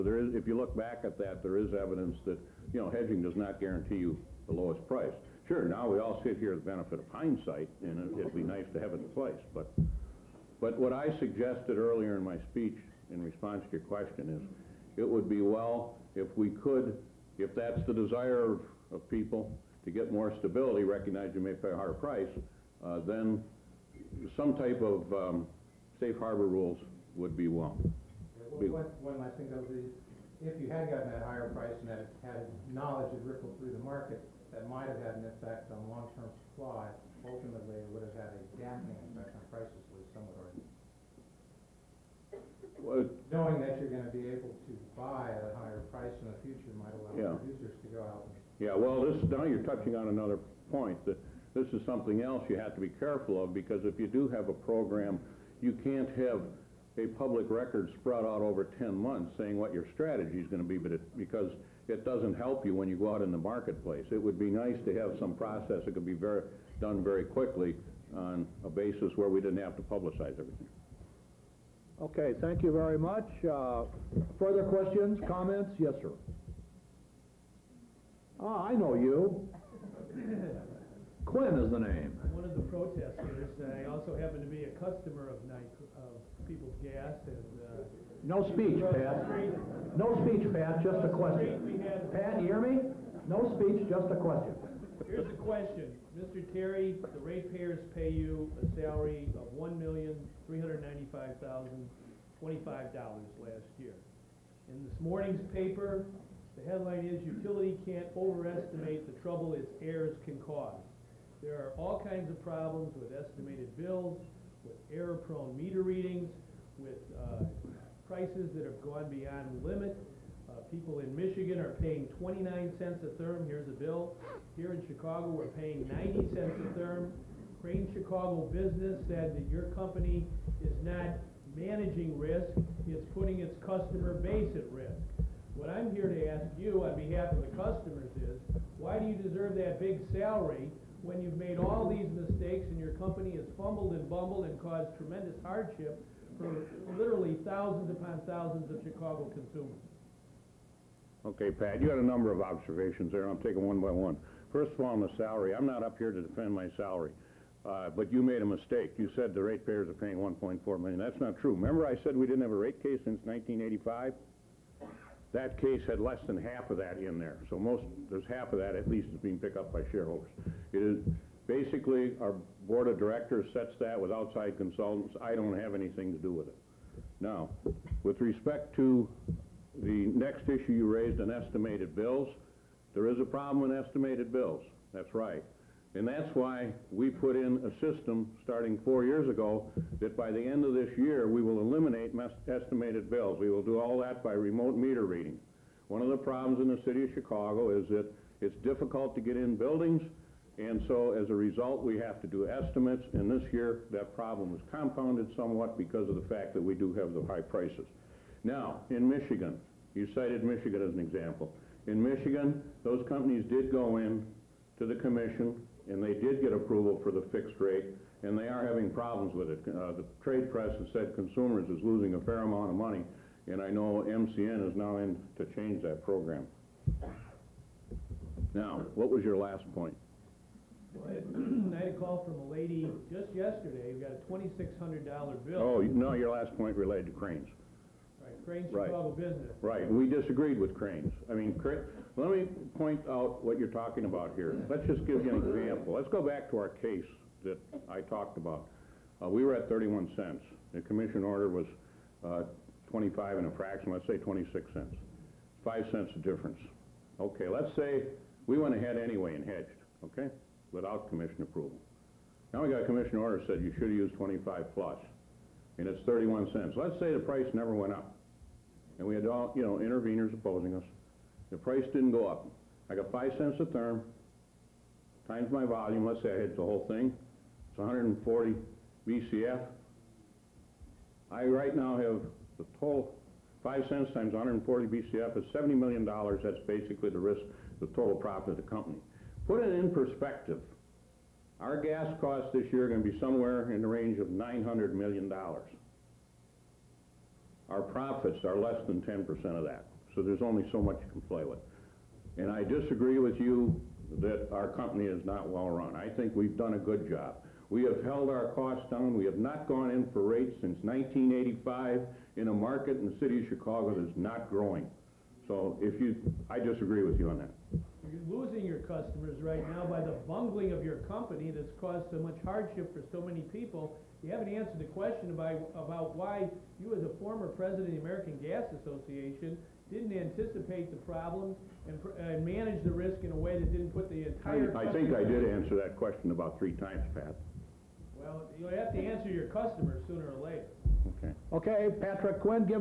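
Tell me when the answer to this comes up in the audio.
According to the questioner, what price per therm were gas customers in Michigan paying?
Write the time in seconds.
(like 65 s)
122 s.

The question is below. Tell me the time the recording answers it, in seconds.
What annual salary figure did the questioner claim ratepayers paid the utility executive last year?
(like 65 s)
99 s.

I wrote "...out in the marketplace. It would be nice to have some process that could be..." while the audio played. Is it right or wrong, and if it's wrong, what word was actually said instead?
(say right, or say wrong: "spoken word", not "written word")
right.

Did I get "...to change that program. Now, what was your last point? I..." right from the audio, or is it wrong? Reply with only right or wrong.
right.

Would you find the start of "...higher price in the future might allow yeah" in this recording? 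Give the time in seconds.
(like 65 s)
45 s.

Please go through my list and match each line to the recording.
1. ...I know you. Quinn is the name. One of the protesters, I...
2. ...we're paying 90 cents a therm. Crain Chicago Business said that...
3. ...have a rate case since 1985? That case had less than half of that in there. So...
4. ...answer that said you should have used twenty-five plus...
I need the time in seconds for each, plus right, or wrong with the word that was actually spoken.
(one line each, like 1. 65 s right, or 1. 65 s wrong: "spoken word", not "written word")
1. 78 s right
2. 125 s right
3. 162 s right
4. 263 s wrong: "order", not "answer".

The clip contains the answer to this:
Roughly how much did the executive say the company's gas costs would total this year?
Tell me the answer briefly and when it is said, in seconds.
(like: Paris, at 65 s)
$900 million, at 294 s.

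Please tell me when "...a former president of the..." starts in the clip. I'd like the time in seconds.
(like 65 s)
327 s.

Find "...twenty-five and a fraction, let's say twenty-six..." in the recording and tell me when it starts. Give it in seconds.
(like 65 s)
252 s.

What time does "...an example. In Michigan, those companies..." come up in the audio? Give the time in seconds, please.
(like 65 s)
210 s.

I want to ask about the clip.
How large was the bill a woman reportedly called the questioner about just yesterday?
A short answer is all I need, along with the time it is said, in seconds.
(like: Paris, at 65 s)
$2,600, at 234 s.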